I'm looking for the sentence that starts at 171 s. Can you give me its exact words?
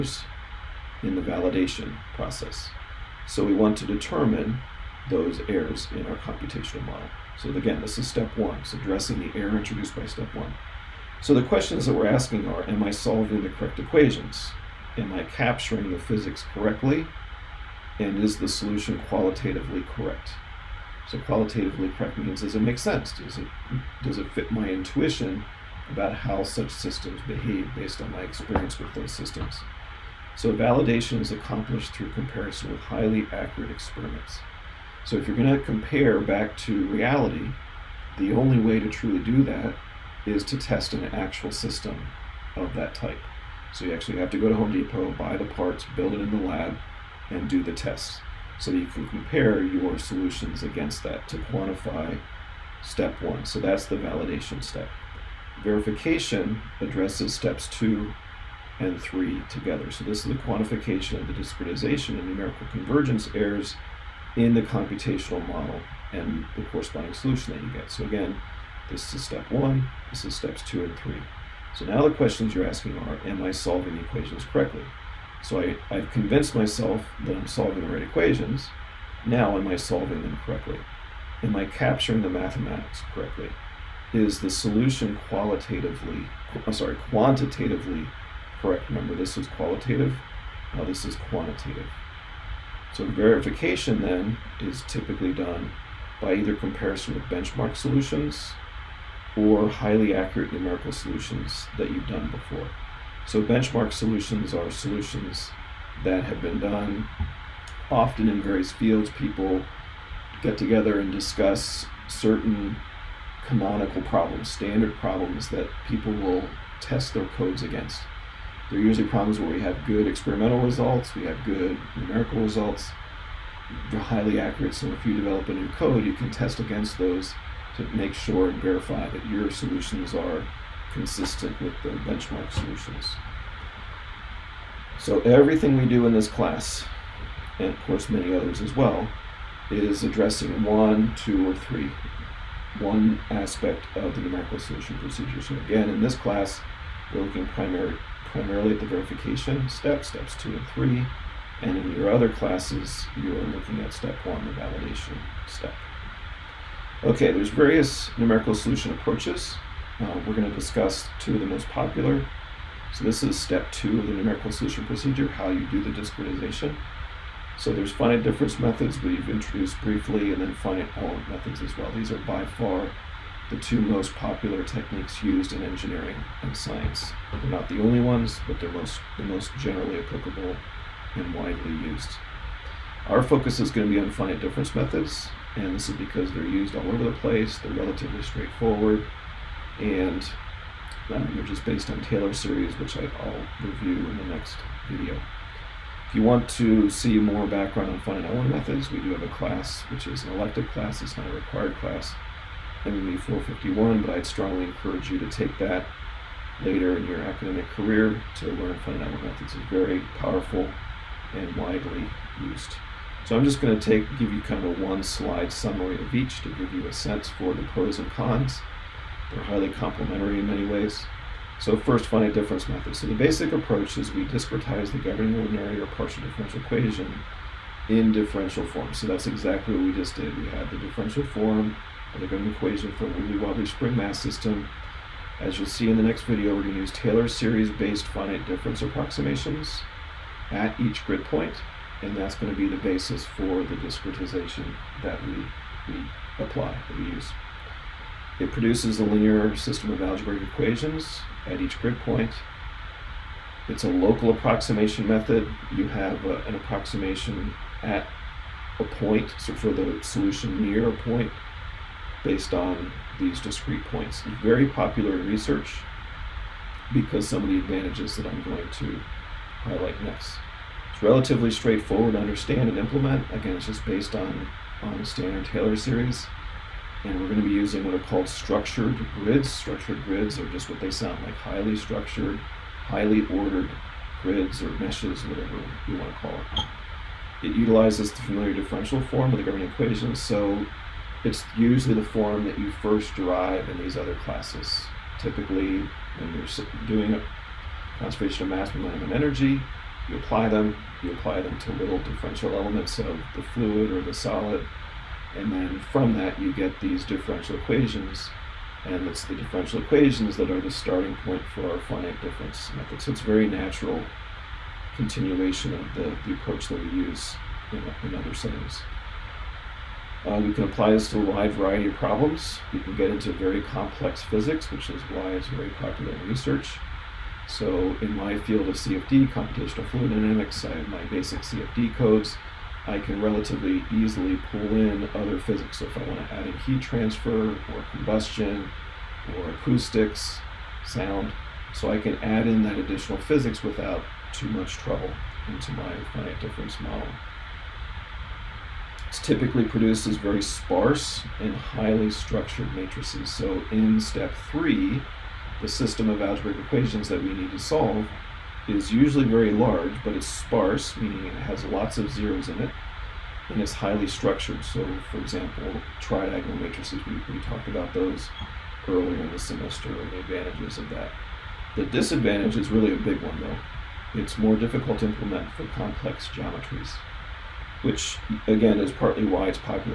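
These are by far the two most popular techniques used in engineering and science.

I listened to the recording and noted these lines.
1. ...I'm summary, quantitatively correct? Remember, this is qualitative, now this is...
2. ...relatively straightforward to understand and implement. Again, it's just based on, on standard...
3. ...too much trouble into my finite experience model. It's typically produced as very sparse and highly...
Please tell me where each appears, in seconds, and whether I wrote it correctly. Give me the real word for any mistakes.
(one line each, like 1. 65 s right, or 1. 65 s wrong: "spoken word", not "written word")
1. 86 s wrong: "sorry", not "summary"
2. 271 s right
3. 344 s wrong: "difference", not "experience".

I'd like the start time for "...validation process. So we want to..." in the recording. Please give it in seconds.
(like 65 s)
1 s.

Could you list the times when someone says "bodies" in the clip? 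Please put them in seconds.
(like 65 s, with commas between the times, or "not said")
not said.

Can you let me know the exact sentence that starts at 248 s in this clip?
It produces a linear system of algebraic equations at each grid point.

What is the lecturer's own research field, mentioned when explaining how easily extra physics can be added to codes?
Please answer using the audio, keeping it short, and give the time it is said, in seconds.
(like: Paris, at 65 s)
Computational fluid dynamics, at 329 s.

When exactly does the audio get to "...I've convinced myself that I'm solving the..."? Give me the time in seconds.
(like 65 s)
75 s.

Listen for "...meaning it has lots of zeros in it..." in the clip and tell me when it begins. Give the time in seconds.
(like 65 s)
360 s.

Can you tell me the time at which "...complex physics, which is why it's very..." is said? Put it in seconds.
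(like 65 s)
323 s.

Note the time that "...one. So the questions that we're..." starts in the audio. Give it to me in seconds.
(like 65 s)
10 s.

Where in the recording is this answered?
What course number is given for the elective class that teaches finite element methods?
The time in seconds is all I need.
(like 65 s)
202 s.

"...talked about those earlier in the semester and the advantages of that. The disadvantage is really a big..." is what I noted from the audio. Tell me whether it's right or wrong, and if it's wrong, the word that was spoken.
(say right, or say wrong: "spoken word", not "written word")
right.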